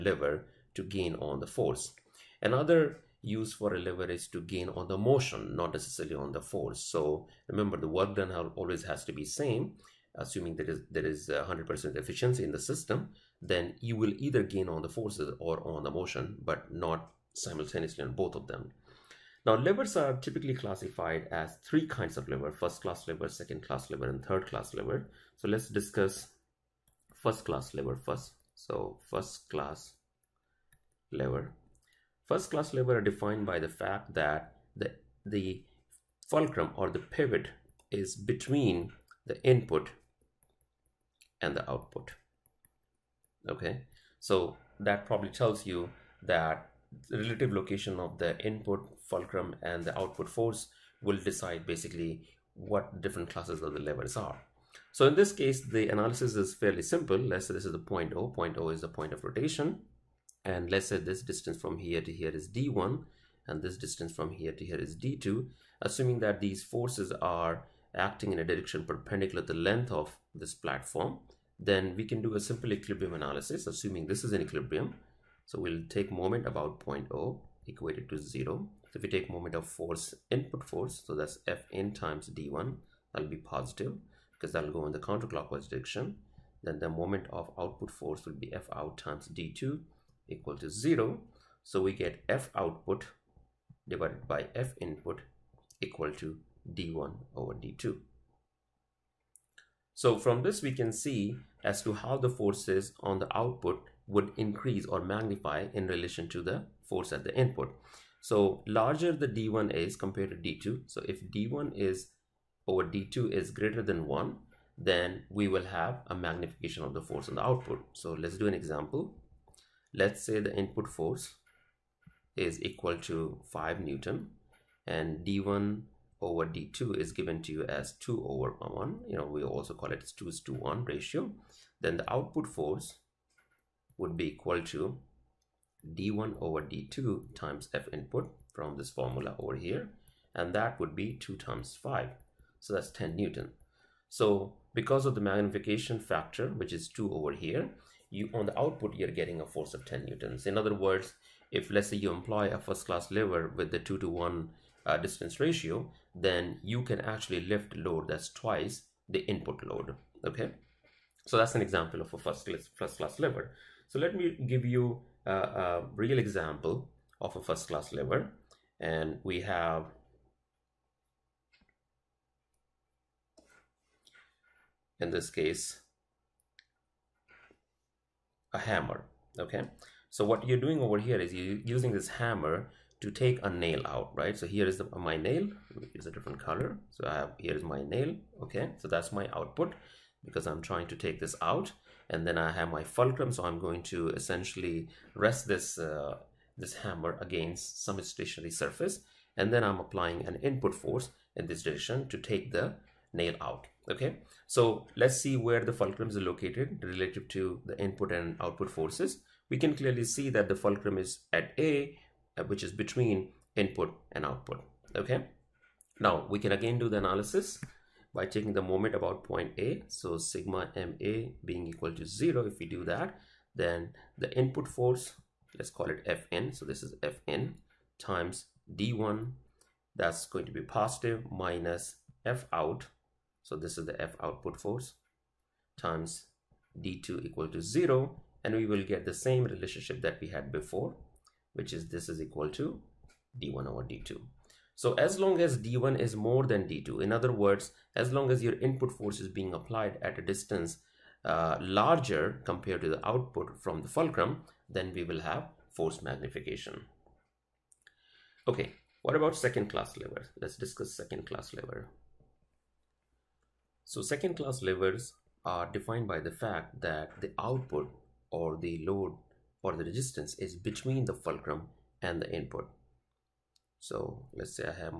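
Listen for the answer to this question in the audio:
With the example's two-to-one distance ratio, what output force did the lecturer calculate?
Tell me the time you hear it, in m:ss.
2:22.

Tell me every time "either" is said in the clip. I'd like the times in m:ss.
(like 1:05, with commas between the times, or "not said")
0:14.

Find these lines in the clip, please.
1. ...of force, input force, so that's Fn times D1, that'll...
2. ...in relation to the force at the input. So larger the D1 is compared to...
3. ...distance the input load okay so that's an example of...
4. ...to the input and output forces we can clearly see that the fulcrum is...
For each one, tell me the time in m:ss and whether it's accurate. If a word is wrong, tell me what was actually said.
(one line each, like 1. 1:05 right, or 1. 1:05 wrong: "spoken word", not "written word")
1. 1:19 right
2. 1:45 right
3. 2:38 wrong: "twice", not "distance"
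4. 3:27 right.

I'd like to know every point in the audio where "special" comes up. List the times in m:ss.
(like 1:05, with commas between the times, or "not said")
not said.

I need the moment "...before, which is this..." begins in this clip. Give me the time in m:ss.
4:00.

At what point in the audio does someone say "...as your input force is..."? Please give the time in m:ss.
4:08.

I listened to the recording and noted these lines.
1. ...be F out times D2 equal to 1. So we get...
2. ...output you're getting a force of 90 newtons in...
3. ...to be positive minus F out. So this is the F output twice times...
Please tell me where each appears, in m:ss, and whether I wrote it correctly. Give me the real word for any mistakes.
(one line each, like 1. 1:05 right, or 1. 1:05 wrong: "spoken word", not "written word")
1. 1:28 wrong: "0", not "1"
2. 2:28 wrong: "10", not "90"
3. 3:50 wrong: "force", not "twice".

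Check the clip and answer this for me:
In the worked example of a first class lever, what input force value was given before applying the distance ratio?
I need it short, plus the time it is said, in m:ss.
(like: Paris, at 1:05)
5 newtons, at 2:03.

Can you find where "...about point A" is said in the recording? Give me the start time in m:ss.
3:38.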